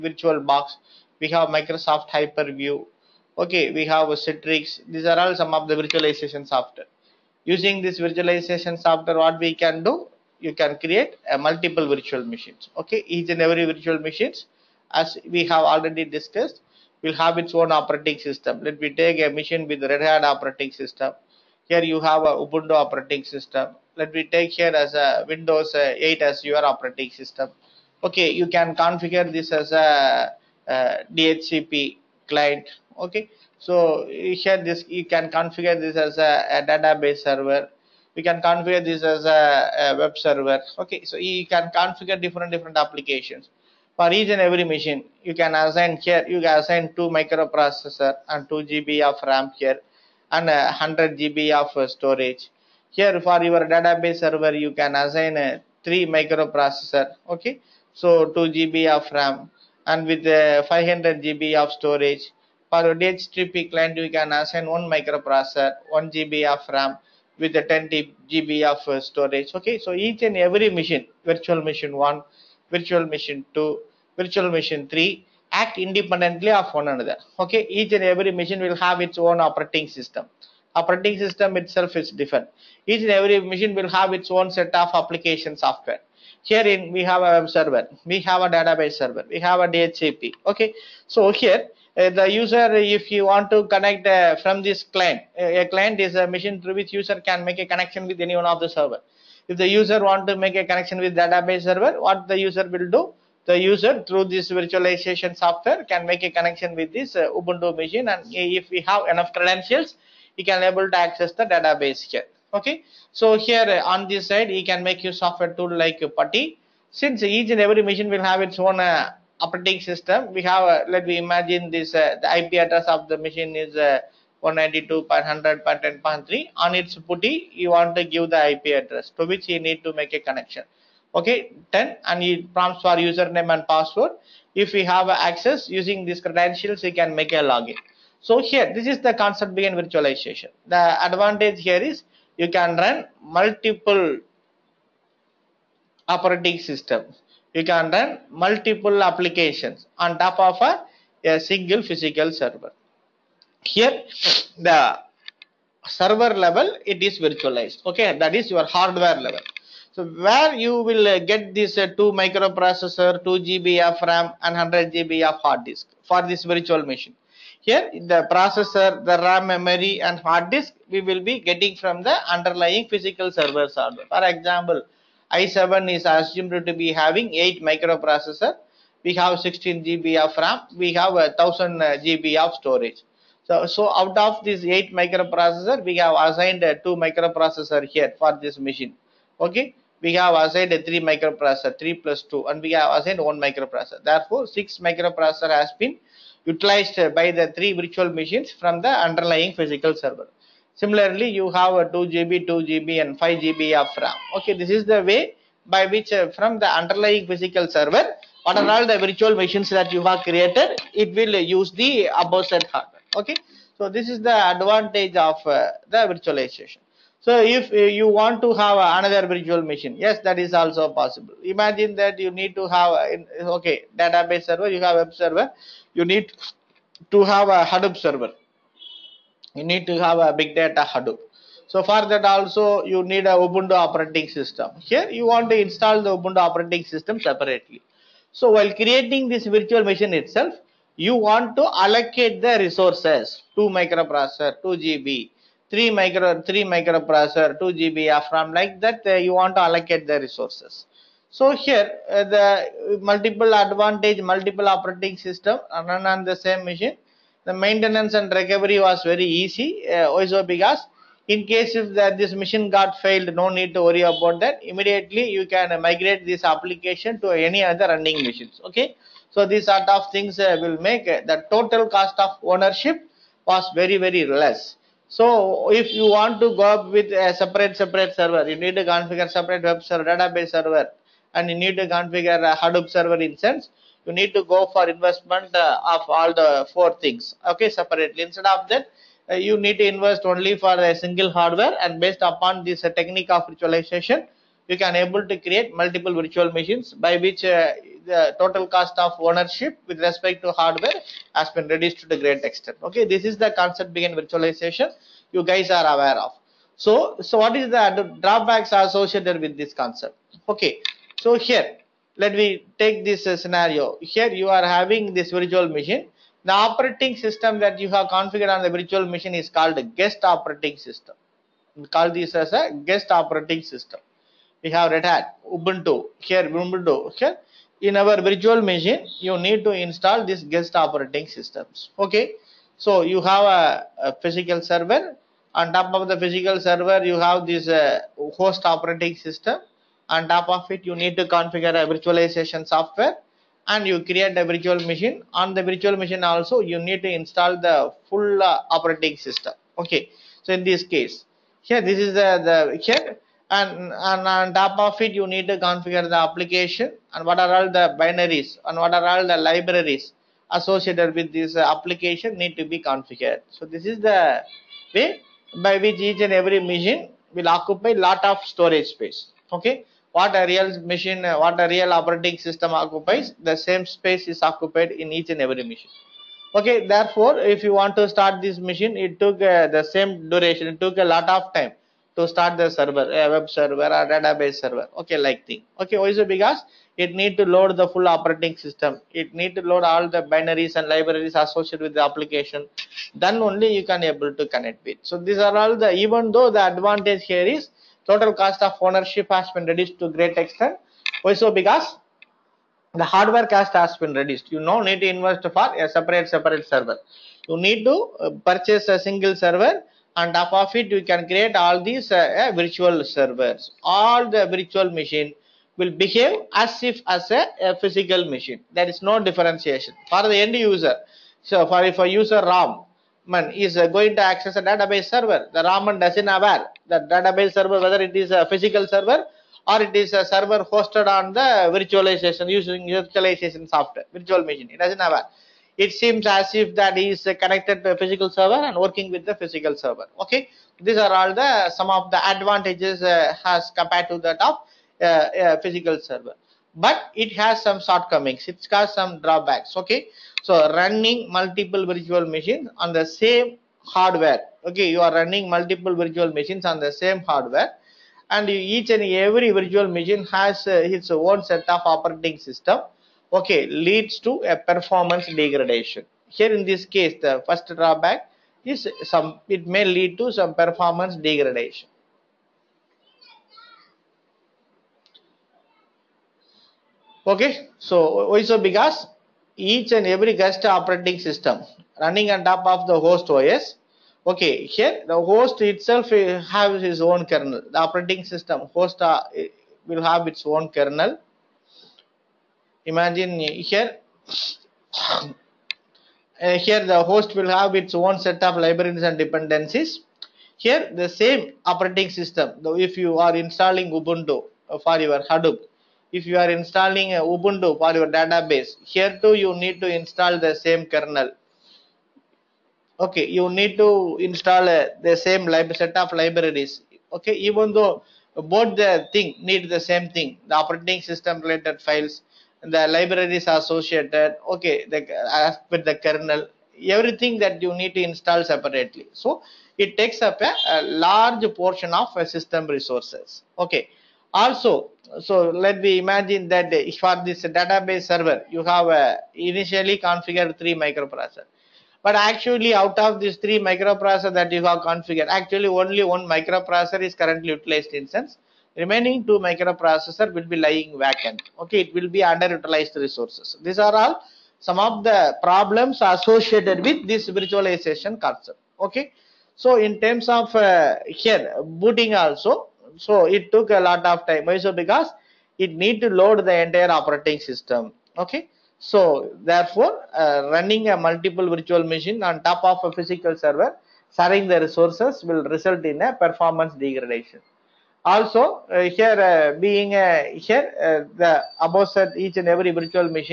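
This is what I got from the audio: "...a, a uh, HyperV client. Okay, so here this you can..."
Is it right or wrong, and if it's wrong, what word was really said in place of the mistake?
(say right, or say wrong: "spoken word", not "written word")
wrong: "DHCP", not "HyperV".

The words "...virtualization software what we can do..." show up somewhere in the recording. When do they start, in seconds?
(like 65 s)
7 s.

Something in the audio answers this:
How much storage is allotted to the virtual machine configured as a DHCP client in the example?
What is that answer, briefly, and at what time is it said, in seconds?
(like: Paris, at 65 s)
10 GB, at 67 s.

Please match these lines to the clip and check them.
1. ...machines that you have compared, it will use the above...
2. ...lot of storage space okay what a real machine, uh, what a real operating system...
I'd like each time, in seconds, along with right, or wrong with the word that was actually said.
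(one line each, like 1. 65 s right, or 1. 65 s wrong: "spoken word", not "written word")
1. 209 s wrong: "created", not "compared"
2. 367 s right.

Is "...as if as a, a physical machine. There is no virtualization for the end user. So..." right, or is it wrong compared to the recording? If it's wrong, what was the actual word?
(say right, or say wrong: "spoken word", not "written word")
wrong: "differentiation", not "virtualization".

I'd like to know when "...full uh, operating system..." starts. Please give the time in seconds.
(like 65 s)
348 s.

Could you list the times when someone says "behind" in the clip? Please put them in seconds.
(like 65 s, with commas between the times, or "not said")
139 s, 303 s.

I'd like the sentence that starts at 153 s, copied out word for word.
Here, the server level, it is virtualized.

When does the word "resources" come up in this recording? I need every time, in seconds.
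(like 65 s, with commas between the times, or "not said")
242 s, 250 s, 532 s, 552 s, 574 s.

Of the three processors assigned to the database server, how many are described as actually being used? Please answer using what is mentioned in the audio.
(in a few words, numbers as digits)
1.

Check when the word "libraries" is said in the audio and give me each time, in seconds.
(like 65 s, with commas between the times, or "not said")
359 s, 390 s, 498 s, 516 s, 522 s.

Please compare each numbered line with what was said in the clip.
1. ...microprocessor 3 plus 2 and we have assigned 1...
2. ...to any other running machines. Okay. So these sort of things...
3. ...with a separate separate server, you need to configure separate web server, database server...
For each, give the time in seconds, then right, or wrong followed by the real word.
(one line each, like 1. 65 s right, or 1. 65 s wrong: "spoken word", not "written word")
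1. 191 s right
2. 267 s right
3. 276 s right.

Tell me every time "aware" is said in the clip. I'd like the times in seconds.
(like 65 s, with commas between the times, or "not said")
305 s, 426 s, 435 s.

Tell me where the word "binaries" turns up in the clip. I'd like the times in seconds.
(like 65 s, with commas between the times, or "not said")
357 s, 390 s.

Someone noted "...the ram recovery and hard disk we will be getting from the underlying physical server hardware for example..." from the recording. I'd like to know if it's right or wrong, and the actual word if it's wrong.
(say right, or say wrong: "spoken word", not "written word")
wrong: "memory", not "recovery".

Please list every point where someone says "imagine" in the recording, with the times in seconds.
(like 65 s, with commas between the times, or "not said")
121 s, 221 s, 492 s, 535 s.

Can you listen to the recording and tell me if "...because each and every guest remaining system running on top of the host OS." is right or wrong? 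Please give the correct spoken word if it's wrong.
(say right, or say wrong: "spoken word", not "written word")
wrong: "operating", not "remaining".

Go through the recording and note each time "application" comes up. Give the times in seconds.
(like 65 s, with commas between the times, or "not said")
42 s, 84 s, 149 s, 266 s, 356 s, 361 s, 392 s.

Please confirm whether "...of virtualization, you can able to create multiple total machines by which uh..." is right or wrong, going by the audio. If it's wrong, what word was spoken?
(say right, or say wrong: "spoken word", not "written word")
wrong: "virtual", not "total".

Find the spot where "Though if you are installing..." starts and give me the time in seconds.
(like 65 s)
502 s.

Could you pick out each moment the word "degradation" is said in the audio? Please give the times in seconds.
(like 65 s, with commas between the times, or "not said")
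465 s, 471 s, 576 s.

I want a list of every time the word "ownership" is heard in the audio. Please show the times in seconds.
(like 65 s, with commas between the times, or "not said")
272 s, 299 s, 398 s.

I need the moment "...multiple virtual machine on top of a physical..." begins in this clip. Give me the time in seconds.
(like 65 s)
570 s.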